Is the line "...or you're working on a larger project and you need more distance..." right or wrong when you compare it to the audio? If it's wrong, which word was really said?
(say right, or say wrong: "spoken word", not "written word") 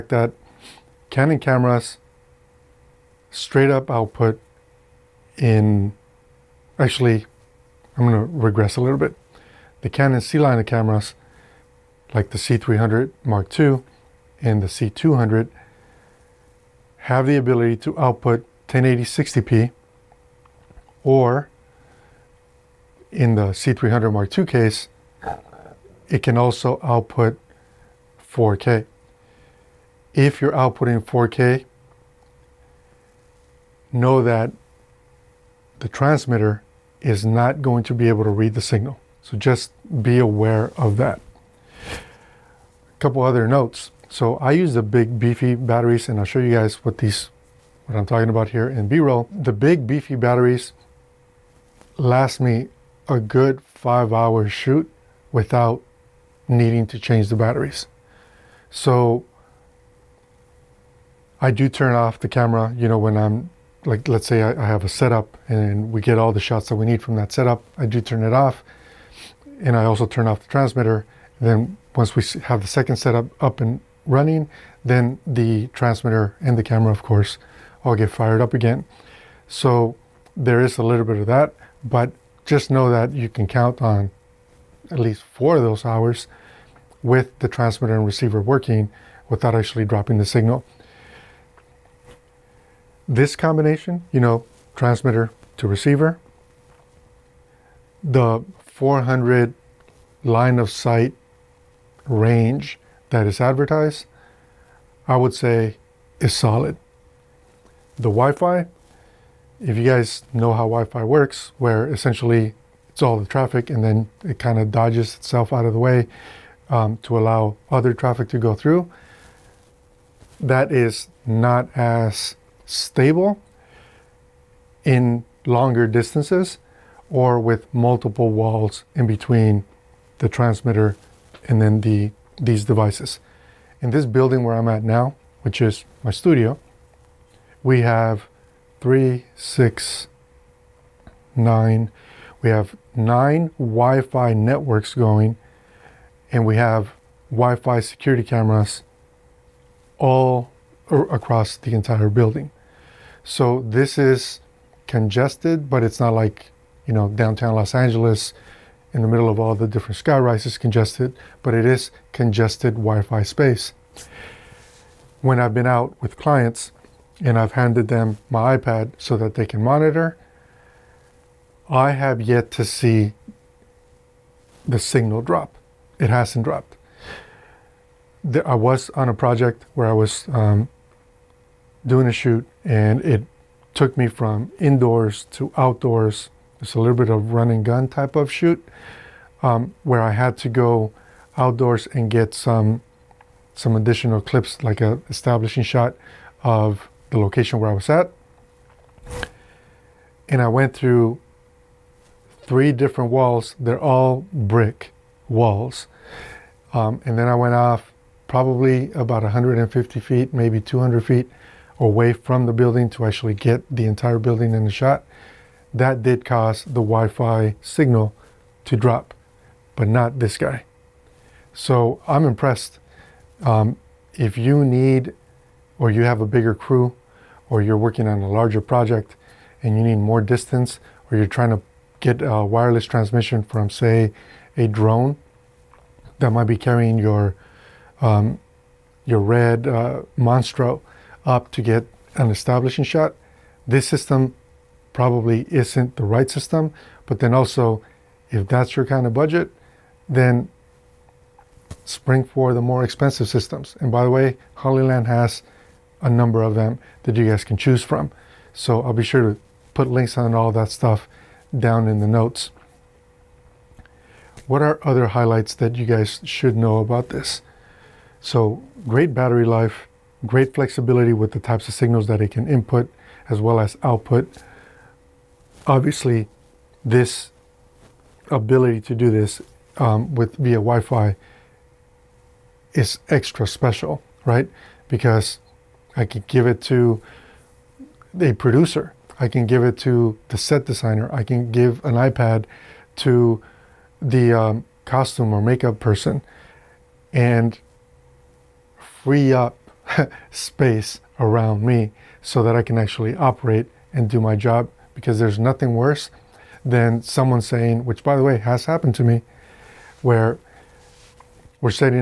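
right.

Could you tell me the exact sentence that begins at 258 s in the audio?
So I'll be sure to put links on all that stuff down in the notes.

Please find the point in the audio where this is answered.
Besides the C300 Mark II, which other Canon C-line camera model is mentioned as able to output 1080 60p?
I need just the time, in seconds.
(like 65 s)
14 s.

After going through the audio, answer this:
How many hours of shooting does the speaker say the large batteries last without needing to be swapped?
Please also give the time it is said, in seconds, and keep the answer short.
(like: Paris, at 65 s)
5, at 53 s.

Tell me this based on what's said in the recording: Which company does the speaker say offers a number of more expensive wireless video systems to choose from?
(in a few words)
Hollyland.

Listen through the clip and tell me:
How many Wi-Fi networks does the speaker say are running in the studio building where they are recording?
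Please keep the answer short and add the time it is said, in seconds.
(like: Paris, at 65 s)
9, at 142 s.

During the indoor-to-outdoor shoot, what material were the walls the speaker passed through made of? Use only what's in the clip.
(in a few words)
brick.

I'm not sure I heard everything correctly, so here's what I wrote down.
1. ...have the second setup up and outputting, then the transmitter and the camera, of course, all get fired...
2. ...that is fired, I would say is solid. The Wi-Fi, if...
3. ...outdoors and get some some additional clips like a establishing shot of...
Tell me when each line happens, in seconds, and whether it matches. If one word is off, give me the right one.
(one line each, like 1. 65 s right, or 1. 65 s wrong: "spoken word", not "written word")
1. 72 s wrong: "running", not "outputting"
2. 103 s wrong: "advertised", not "fired"
3. 191 s right.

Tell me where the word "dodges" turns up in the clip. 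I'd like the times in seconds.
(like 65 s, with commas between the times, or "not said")
114 s.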